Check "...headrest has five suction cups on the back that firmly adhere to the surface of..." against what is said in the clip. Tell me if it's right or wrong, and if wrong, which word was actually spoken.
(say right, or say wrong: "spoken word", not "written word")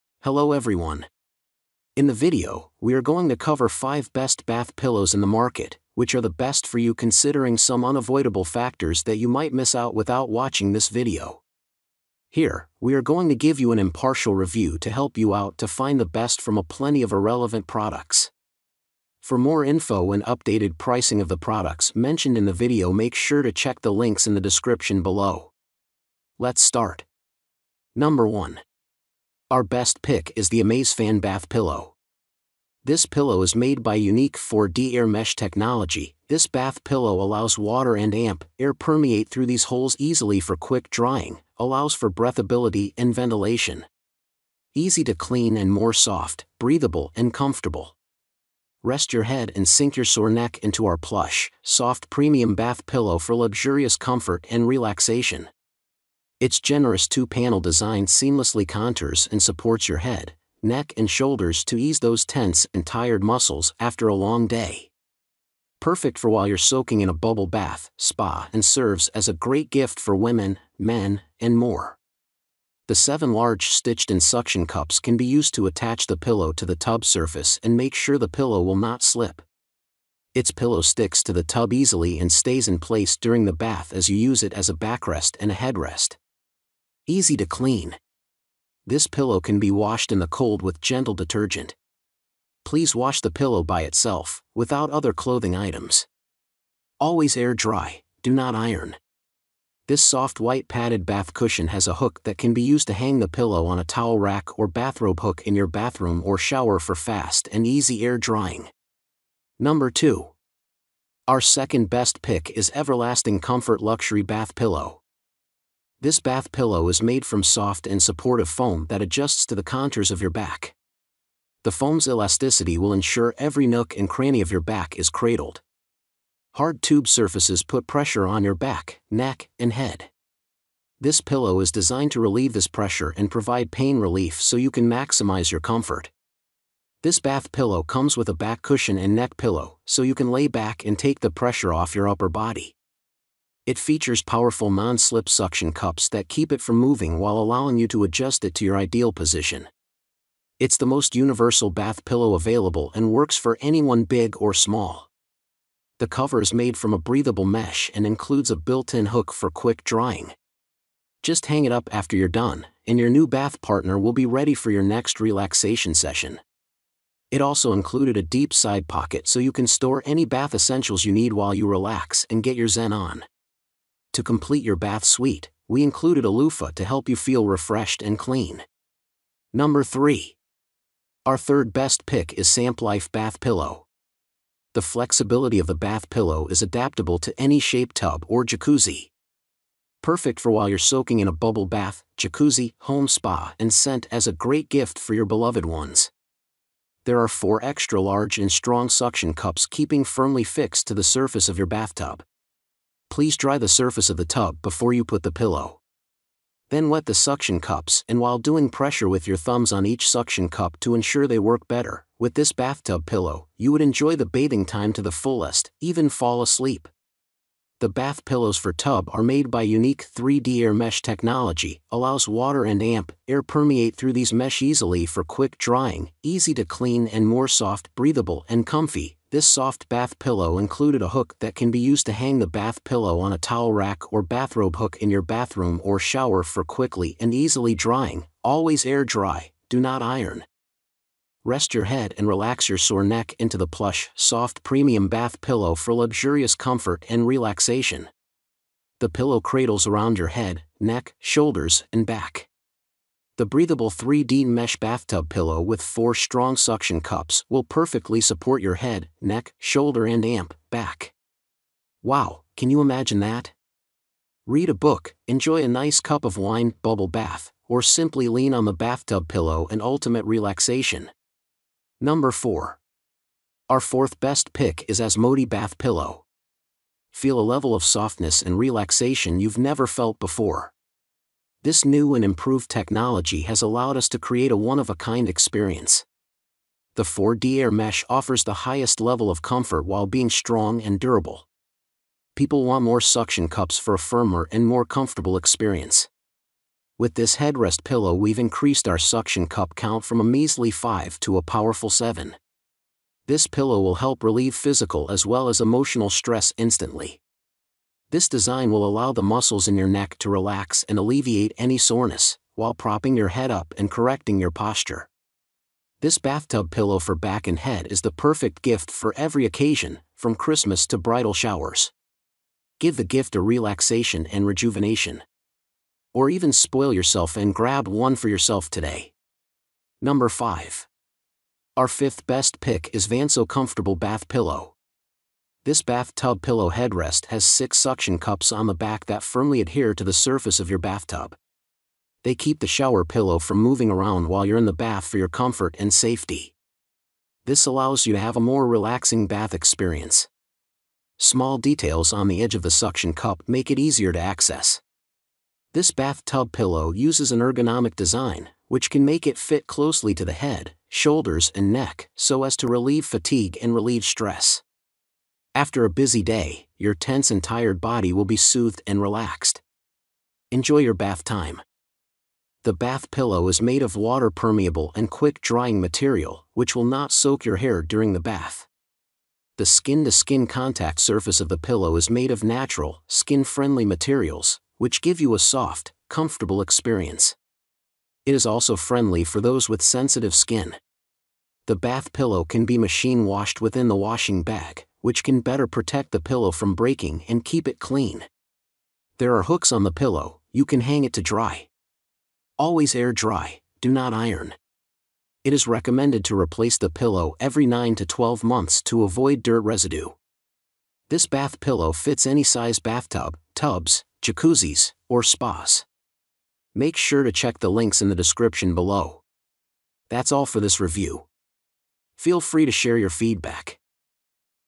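wrong: "six", not "five".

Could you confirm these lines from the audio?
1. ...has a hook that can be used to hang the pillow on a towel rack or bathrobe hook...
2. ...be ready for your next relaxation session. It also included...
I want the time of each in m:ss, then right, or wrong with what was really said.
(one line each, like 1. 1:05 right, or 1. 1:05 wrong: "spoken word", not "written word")
1. 1:41 right
2. 2:44 right.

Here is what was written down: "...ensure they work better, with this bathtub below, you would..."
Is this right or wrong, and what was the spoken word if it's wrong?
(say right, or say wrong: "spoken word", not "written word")
wrong: "pillow", not "below".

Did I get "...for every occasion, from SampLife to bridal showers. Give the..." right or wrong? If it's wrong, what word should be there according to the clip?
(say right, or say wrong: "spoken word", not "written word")
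wrong: "Christmas", not "SampLife".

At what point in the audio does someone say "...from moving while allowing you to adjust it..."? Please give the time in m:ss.
2:26.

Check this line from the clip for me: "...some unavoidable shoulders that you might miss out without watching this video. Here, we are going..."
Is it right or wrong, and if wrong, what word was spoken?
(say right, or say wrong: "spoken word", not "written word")
wrong: "factors", not "shoulders".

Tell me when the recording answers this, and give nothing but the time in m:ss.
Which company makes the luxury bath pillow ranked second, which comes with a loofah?
1:52.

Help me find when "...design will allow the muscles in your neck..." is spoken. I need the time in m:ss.
5:08.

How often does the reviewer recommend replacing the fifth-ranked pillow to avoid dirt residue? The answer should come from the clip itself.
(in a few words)
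Every 9 to 12 months.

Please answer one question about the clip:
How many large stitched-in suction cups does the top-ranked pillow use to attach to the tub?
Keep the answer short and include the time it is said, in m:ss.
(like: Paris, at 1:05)
7, at 1:12.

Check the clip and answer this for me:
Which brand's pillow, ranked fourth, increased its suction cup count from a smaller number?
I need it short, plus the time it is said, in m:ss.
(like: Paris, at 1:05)
Asmodee, at 4:34.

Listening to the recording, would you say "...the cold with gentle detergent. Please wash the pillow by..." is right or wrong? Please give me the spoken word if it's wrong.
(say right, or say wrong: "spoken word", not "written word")
right.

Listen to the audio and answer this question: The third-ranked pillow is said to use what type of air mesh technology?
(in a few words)
3D air mesh.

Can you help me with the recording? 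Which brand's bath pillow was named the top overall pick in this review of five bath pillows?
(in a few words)
AmazeFan.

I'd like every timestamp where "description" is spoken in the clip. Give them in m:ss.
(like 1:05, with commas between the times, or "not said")
0:24, 6:58.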